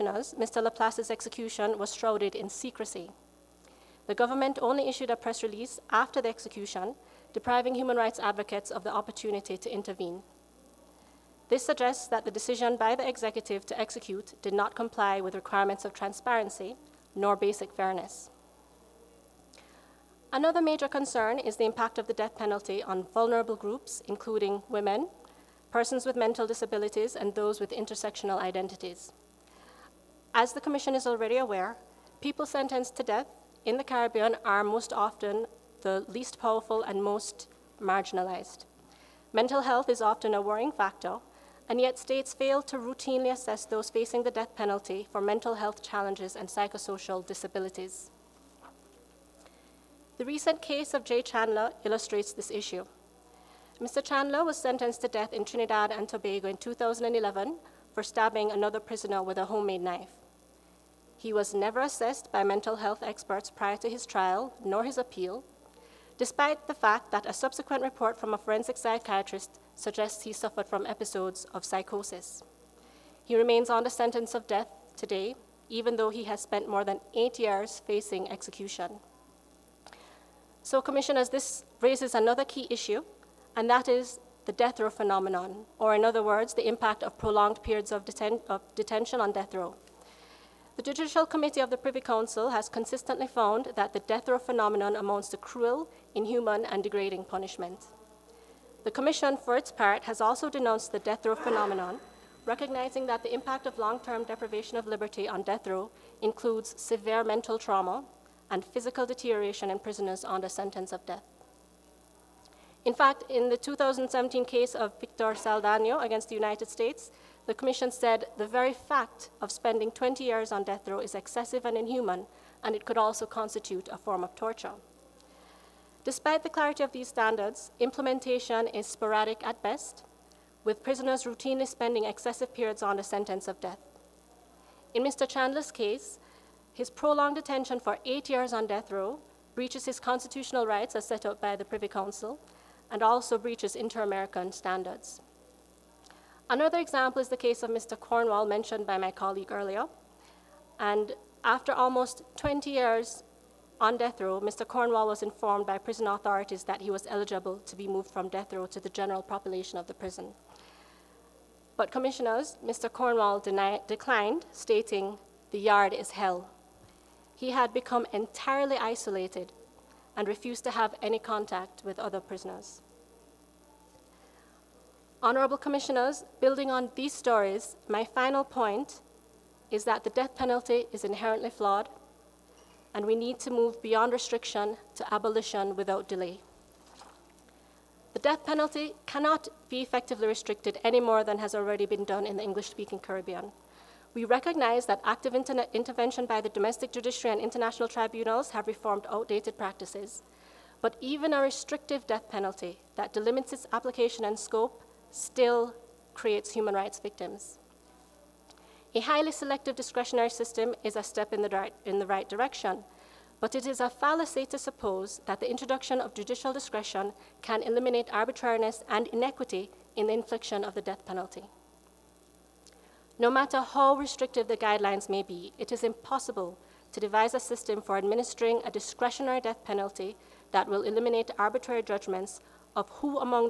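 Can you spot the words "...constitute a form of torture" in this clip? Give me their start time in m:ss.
2:03.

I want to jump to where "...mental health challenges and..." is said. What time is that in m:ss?
0:45.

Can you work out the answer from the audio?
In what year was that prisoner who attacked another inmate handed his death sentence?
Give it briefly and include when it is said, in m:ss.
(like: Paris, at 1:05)
2011, at 0:56.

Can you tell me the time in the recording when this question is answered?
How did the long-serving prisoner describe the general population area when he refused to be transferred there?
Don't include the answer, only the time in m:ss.
2:45.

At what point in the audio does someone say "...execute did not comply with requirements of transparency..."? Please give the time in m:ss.
0:13.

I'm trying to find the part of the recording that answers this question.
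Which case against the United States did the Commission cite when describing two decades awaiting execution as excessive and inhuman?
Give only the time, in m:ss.
1:54.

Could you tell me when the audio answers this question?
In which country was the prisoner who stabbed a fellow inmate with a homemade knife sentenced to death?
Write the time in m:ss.
0:55.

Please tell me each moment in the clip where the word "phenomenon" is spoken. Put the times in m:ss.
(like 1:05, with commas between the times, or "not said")
1:24, 1:34, 1:41.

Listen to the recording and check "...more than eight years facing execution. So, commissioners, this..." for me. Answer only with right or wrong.
right.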